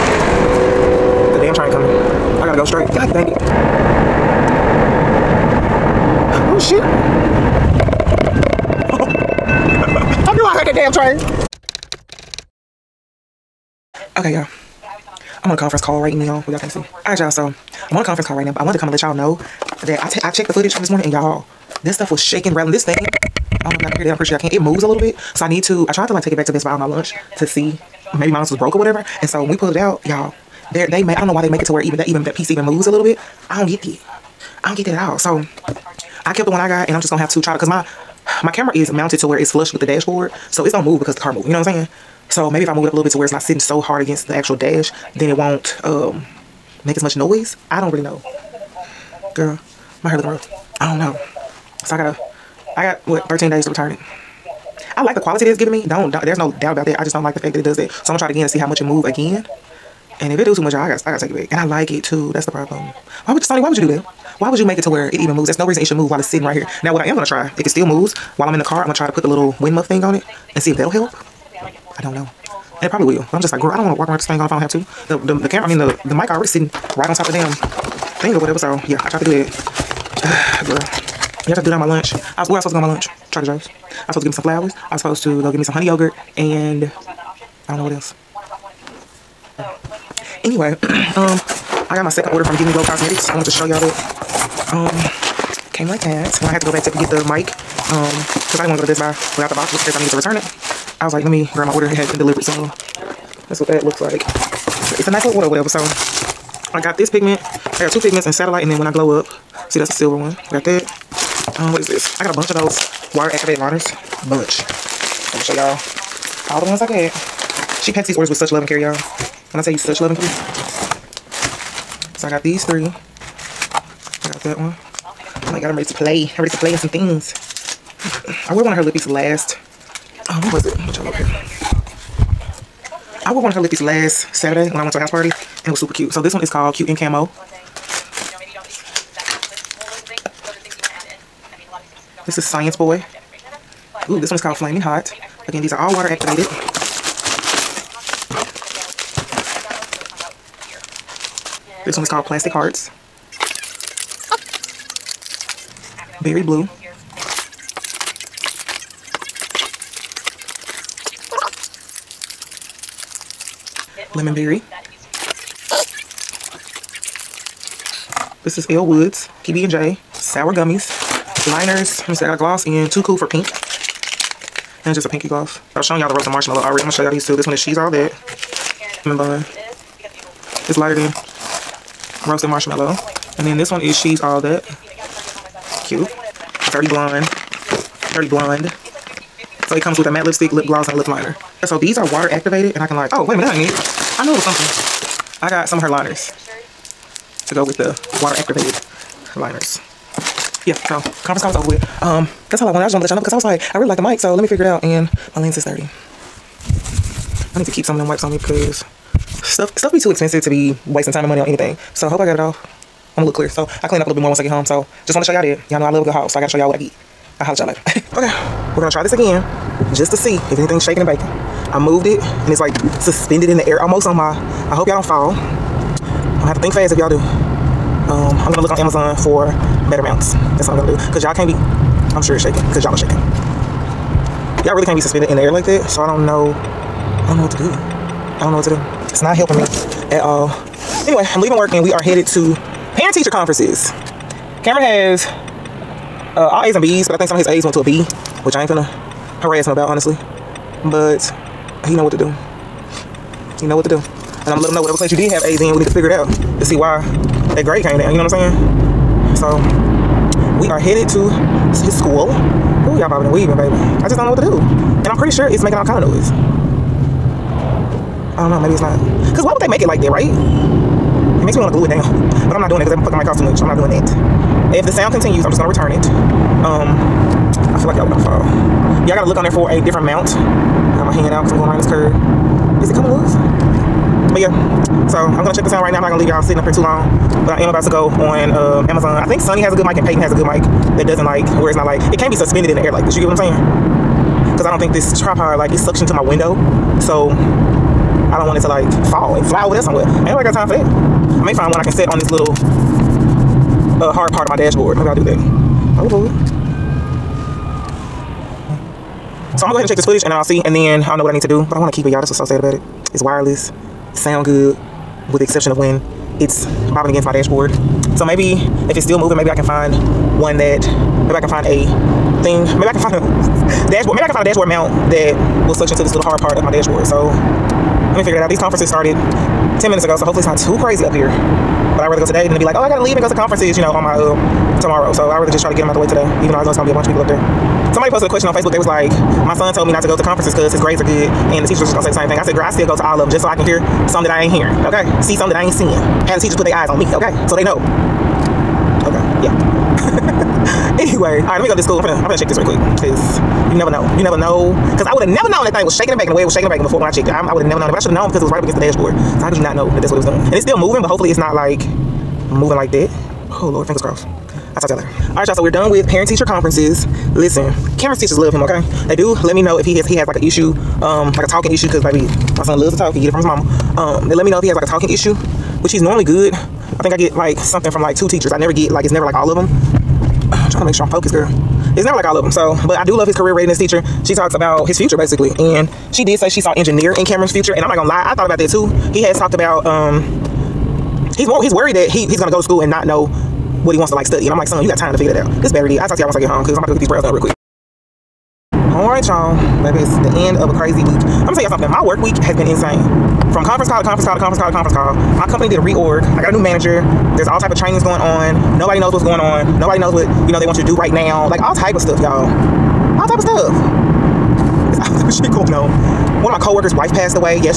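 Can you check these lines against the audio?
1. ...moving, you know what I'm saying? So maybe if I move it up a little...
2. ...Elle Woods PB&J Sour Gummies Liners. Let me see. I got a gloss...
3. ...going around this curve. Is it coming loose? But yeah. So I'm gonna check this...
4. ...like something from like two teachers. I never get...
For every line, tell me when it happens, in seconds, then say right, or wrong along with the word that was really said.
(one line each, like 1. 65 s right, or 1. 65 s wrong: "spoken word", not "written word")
1. 41 s right
2. 168 s right
3. 281 s right
4. 377 s right.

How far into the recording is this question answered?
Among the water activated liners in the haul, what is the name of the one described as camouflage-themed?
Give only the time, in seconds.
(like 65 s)
136 s.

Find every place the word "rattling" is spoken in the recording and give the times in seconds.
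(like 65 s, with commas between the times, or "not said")
22 s.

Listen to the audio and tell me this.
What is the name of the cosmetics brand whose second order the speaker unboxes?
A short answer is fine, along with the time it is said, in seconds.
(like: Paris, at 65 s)
Give Me Glow Cosmetics, at 92 s.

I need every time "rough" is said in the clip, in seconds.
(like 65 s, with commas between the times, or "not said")
50 s.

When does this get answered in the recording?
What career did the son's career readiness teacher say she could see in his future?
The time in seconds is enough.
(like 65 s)
386 s.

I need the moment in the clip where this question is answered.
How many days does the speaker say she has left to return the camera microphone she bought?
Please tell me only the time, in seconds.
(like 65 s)
53 s.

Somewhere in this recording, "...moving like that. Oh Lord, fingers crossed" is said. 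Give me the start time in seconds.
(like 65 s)
362 s.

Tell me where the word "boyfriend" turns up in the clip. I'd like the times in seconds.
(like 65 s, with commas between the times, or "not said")
not said.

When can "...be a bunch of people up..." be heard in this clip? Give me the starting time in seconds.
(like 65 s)
336 s.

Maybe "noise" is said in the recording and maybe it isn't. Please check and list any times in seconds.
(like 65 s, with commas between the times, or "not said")
47 s, 265 s.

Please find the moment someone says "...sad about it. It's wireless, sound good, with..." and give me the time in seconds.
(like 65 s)
312 s.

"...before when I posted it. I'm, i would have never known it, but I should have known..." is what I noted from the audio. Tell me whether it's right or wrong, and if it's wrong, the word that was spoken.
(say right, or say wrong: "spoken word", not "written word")
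wrong: "checked", not "posted".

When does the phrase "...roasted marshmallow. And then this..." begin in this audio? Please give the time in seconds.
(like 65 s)
182 s.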